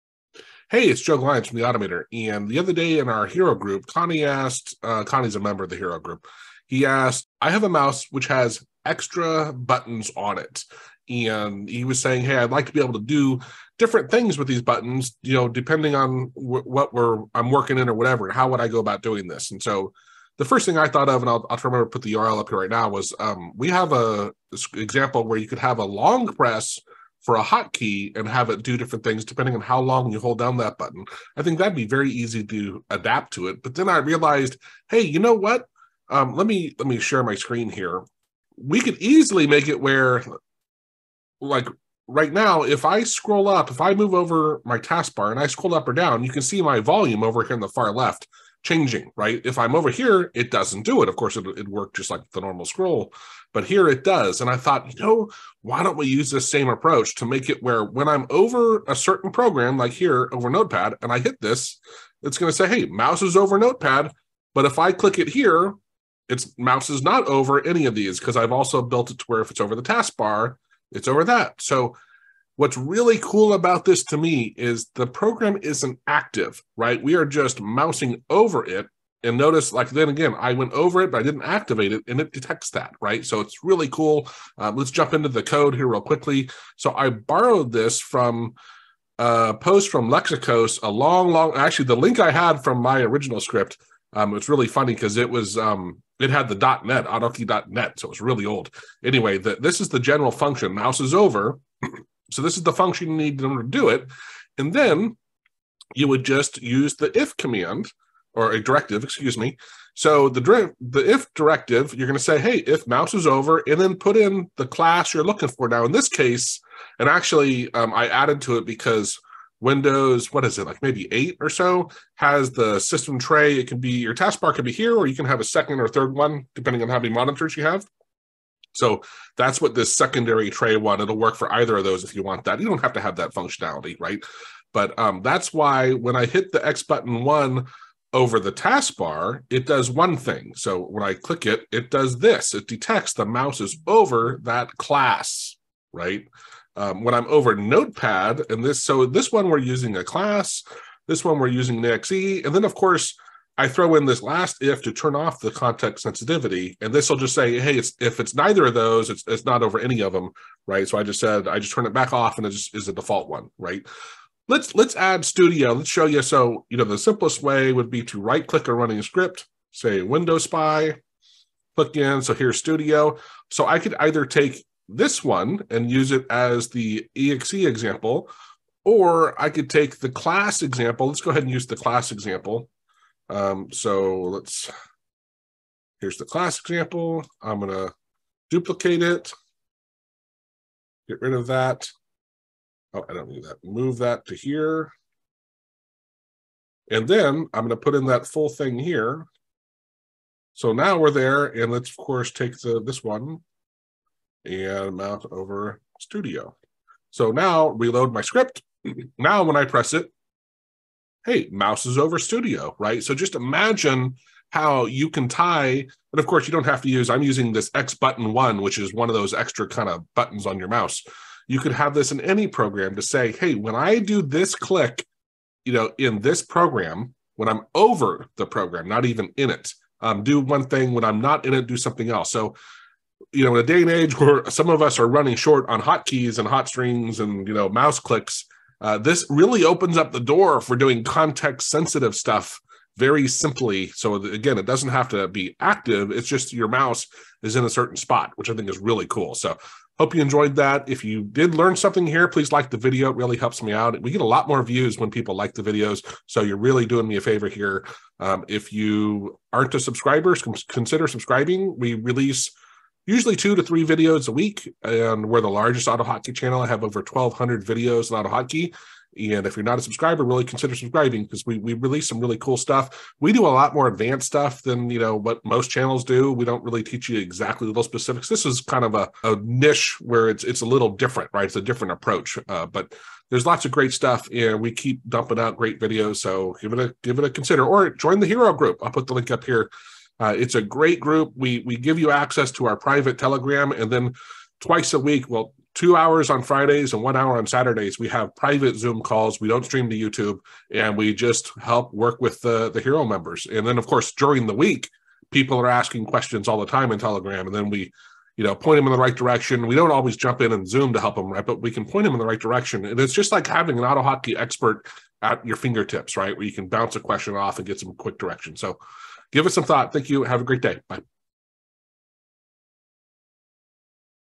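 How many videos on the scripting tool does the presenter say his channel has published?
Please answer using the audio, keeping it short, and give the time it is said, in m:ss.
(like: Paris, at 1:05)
Over 1,200, at 4:26.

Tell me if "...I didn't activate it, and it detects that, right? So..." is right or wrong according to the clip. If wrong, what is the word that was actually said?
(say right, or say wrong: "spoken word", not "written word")
right.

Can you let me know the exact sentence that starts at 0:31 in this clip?
I think that'd be very easy to adapt to it.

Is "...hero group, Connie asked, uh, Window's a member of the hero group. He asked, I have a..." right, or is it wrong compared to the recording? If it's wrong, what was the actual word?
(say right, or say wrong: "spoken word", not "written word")
wrong: "Connie", not "Window".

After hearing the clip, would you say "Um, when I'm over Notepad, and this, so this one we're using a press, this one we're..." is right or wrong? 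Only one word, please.
wrong.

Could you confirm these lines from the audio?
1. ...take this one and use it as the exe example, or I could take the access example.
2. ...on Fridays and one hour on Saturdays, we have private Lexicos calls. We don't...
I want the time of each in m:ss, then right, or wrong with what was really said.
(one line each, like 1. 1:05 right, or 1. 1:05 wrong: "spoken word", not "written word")
1. 2:54 wrong: "class", not "access"
2. 4:56 wrong: "Zoom", not "Lexicos".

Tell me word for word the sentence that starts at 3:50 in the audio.
When I'm not in it, do something else.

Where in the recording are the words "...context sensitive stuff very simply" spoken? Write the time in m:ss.
4:01.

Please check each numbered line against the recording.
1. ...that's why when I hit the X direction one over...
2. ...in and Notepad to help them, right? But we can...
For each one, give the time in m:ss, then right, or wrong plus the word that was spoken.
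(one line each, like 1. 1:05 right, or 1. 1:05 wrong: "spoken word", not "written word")
1. 2:15 wrong: "button", not "direction"
2. 5:10 wrong: "Zoom", not "Notepad".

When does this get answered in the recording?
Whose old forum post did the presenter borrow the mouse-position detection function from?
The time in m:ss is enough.
1:30.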